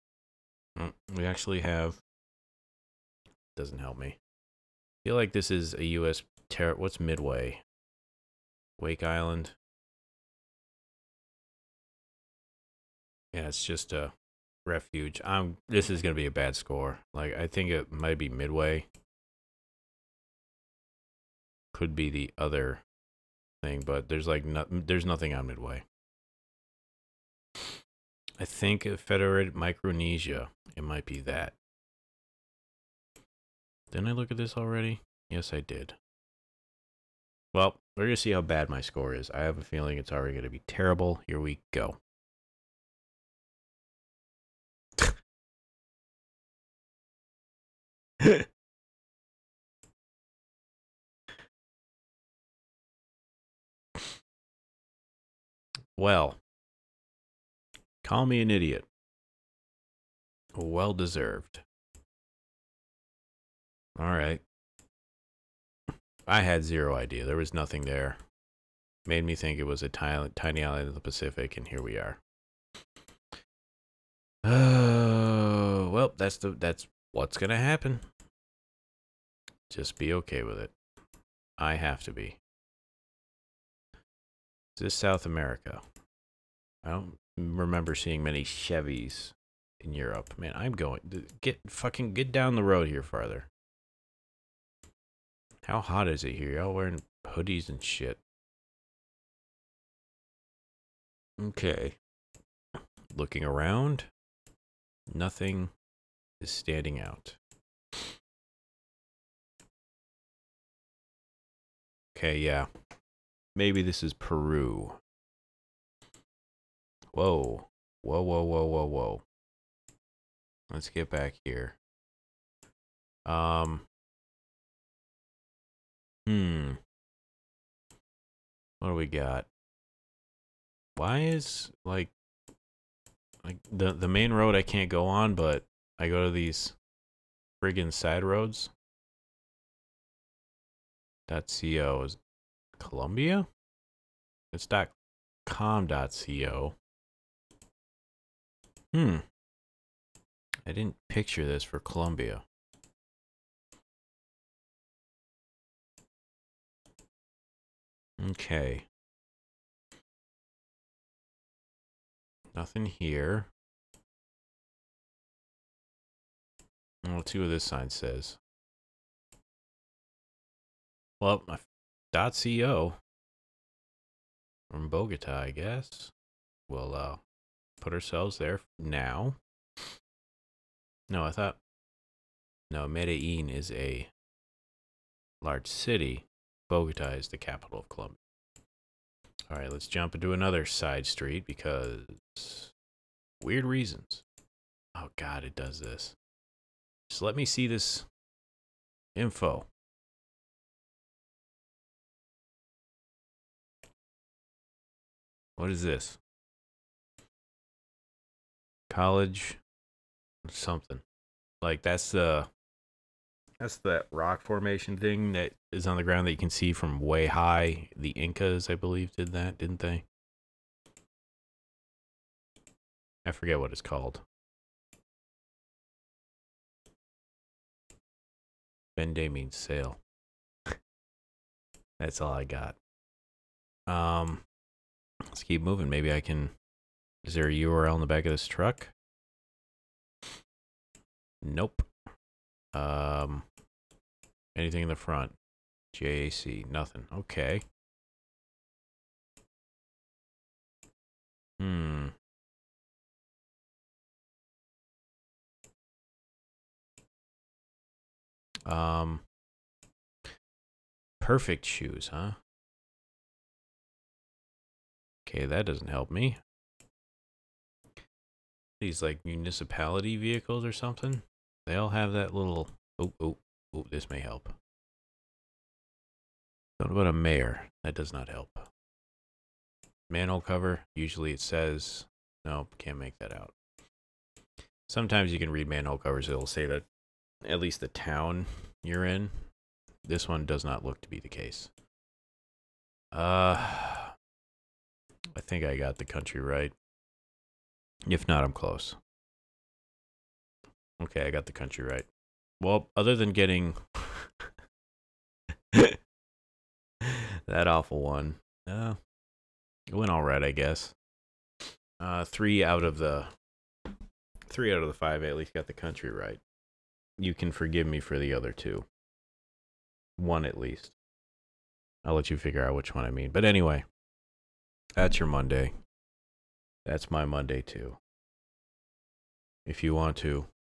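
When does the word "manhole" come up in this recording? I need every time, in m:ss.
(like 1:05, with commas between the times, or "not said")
4:40, 4:45.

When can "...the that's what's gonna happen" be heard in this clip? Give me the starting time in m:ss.
1:16.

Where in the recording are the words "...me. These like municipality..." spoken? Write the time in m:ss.
4:26.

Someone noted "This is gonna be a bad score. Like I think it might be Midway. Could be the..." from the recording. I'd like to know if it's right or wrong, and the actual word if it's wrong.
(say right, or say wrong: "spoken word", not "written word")
right.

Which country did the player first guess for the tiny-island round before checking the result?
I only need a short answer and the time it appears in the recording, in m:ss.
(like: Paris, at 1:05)
Federated Micronesia, at 0:28.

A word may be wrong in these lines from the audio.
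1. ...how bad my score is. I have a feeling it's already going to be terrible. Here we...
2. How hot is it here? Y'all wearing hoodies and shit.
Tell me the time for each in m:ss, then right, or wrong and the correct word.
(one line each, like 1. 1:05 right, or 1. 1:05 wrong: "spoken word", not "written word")
1. 0:38 right
2. 1:35 right.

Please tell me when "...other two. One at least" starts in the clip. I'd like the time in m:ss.
5:18.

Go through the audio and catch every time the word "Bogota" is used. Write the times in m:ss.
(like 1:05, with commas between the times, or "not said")
2:54, 3:06.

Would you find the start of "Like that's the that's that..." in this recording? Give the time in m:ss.
3:31.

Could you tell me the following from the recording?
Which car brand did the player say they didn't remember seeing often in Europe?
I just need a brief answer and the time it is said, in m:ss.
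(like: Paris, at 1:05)
Chevys, at 1:28.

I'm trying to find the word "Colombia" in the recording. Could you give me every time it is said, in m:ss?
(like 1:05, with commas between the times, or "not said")
2:22, 2:31, 3:07.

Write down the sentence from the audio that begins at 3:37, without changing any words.
The Incas, I believe, did that, didn't they?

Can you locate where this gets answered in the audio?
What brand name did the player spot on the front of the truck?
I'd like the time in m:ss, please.
4:05.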